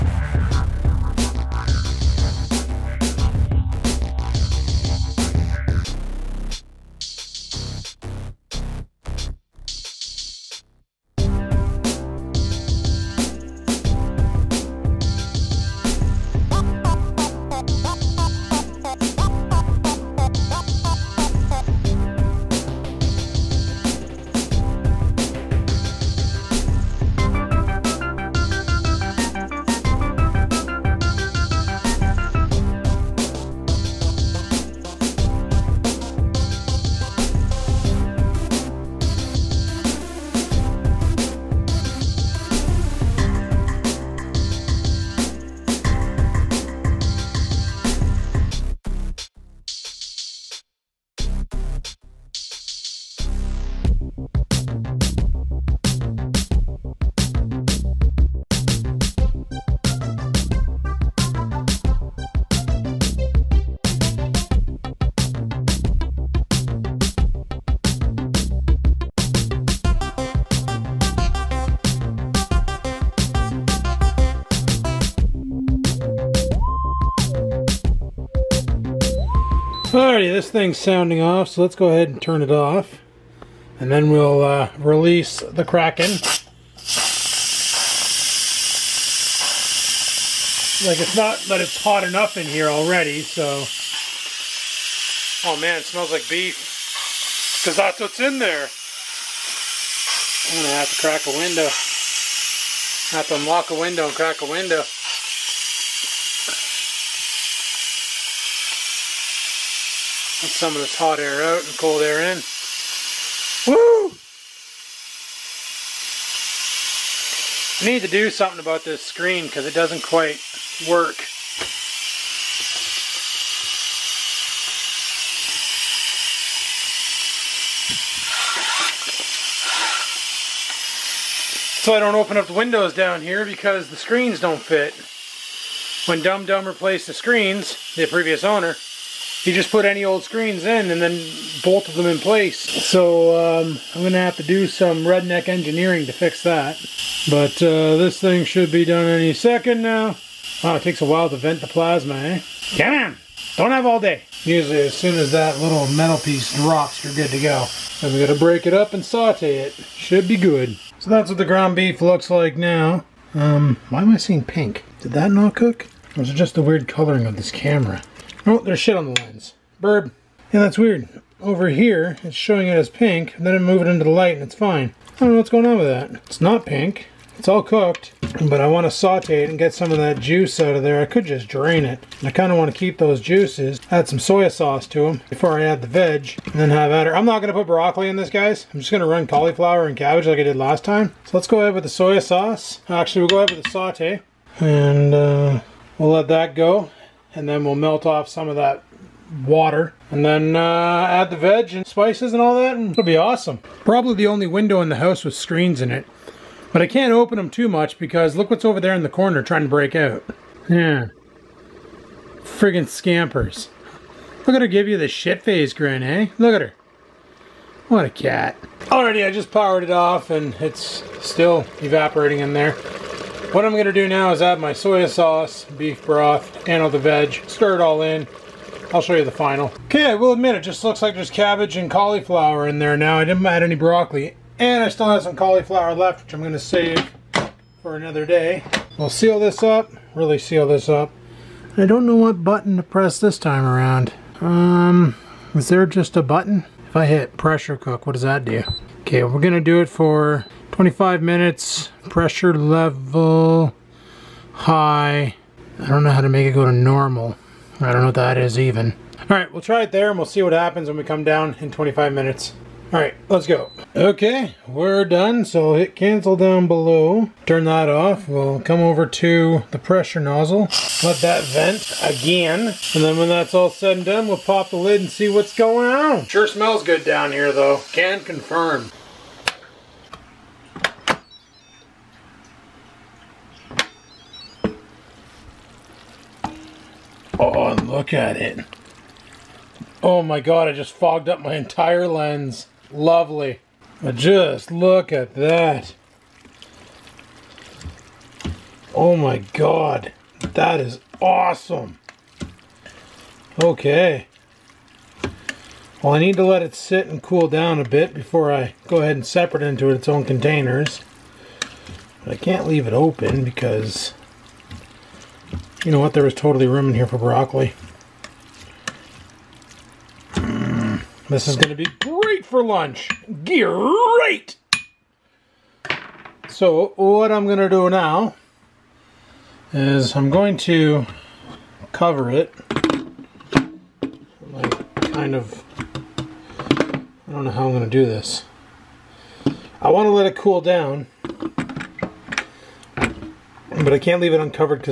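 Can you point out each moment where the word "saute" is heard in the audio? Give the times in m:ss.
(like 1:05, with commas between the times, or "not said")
2:39, 2:58, 3:13.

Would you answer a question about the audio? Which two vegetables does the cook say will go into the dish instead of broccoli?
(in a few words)
cauliflower and cabbage.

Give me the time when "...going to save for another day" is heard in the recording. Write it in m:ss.
3:56.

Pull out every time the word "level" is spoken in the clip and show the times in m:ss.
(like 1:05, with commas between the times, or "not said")
4:12.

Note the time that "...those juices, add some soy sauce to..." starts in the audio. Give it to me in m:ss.
3:02.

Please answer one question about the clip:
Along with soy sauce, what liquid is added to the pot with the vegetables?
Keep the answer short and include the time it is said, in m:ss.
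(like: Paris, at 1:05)
beef broth, at 3:45.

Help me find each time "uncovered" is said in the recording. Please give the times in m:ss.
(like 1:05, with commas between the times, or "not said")
5:44.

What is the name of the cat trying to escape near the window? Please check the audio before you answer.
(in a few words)
Scampers.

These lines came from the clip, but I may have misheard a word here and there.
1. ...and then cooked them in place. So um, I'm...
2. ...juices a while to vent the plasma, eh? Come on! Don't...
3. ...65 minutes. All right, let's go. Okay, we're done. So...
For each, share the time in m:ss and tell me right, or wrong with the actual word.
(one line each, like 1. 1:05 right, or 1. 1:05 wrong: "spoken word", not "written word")
1. 2:20 wrong: "bolted", not "cooked"
2. 2:30 wrong: "takes", not "juices"
3. 4:21 wrong: "25", not "65".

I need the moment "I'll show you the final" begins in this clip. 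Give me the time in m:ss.
3:48.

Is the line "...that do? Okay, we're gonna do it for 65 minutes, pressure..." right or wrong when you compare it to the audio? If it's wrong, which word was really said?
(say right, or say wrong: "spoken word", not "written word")
wrong: "25", not "65".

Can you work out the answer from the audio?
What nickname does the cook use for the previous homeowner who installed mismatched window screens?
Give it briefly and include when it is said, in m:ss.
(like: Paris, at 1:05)
Dum Dum, at 2:16.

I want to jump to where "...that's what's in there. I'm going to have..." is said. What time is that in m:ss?
1:37.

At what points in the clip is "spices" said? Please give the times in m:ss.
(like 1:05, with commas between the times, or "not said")
3:21.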